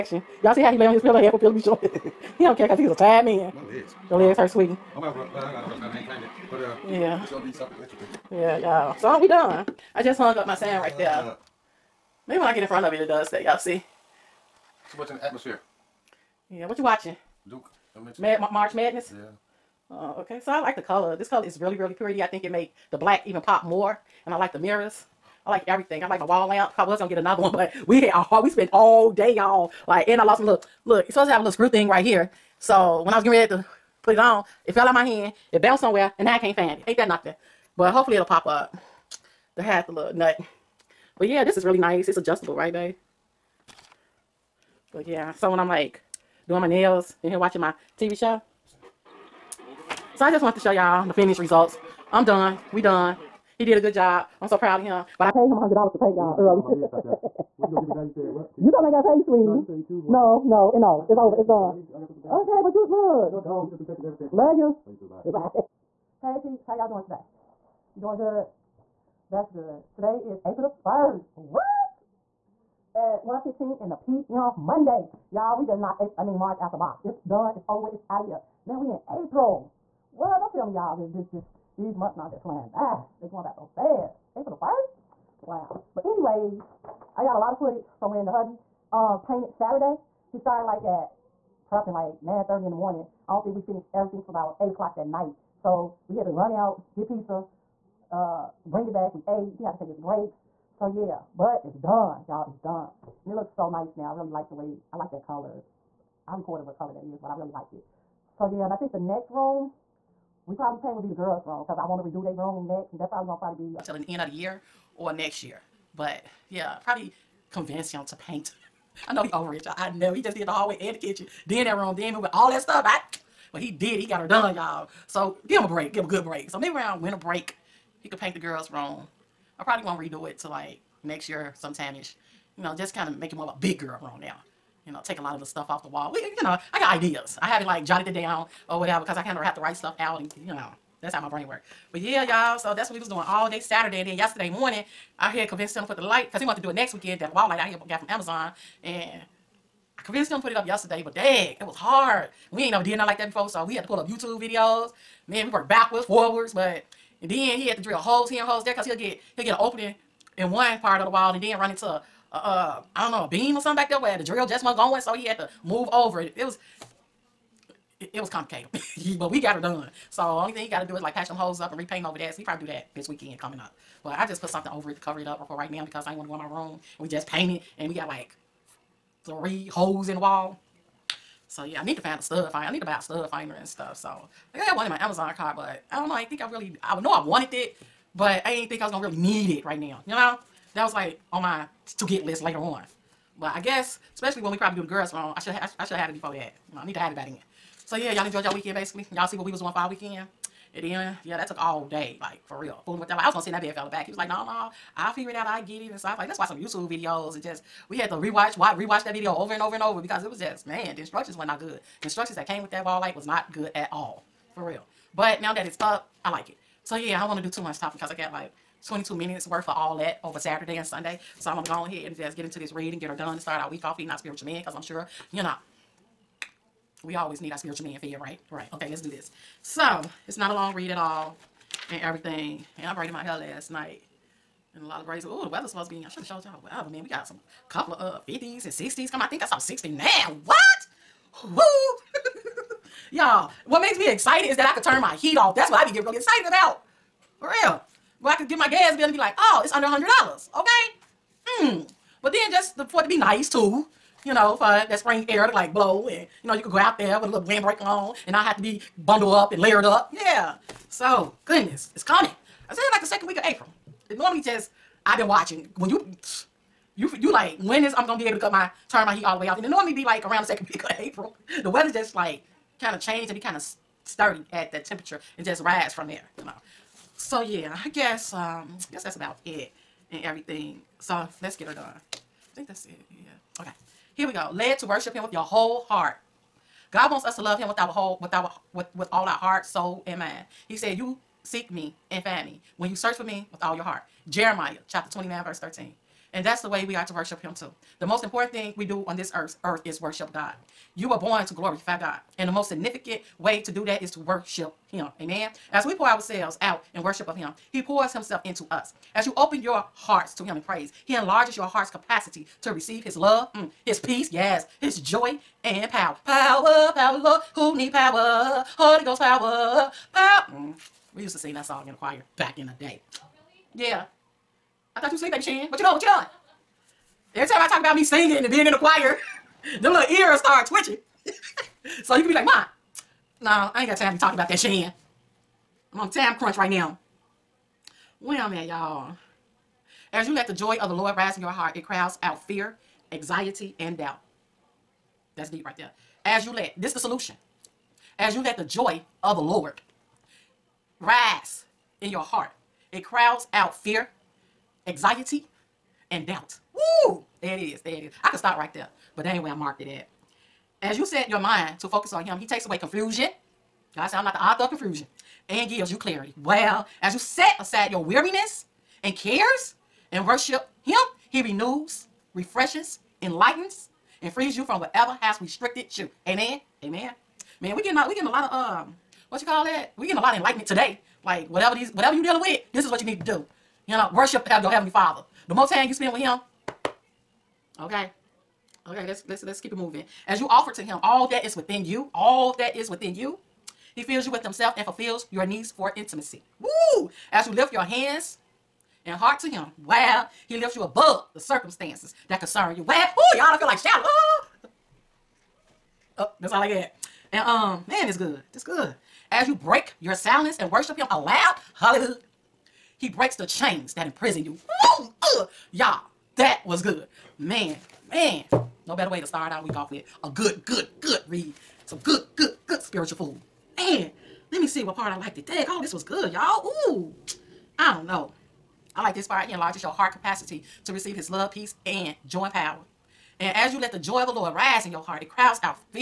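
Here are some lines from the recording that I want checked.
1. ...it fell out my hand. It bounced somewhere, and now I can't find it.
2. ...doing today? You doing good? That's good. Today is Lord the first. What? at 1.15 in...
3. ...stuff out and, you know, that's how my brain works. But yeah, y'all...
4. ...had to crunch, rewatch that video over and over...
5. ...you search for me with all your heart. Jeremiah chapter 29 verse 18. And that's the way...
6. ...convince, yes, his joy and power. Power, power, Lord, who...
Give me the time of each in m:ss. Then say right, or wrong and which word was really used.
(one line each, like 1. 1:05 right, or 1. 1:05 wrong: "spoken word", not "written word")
1. 0:34 right
2. 1:06 wrong: "April", not "Lord"
3. 2:19 right
4. 3:27 wrong: "rewatch", not "crunch"
5. 4:52 wrong: "13", not "18"
6. 5:13 wrong: "peace", not "convince".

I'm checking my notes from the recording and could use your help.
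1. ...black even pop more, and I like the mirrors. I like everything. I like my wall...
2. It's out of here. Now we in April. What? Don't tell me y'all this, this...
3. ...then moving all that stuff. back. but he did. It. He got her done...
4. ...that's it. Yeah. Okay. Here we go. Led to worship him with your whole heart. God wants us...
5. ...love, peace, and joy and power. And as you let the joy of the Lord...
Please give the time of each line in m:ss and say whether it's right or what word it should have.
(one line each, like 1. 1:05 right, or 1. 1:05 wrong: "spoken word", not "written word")
1. 0:22 right
2. 1:17 right
3. 2:01 right
4. 4:42 right
5. 7:11 right.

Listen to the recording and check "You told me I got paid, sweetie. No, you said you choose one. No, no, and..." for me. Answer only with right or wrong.
right.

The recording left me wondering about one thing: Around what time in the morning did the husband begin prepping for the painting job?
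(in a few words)
9:30.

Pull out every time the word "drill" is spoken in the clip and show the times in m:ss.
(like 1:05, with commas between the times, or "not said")
2:37, 2:44.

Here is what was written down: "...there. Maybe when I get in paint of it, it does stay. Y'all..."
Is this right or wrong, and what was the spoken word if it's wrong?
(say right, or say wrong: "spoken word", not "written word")
wrong: "front", not "paint".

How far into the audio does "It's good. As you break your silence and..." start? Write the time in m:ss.
6:48.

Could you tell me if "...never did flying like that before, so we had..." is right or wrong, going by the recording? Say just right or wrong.
wrong.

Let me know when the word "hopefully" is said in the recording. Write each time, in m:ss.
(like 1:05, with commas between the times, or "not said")
0:37.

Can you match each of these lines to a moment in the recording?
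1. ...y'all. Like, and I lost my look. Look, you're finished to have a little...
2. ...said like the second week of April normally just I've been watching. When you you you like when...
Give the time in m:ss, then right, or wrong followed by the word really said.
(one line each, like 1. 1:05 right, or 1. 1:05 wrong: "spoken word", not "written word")
1. 0:29 wrong: "supposed", not "finished"
2. 4:22 right.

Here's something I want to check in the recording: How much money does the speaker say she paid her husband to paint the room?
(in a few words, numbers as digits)
$100.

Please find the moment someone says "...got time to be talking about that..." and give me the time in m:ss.
5:33.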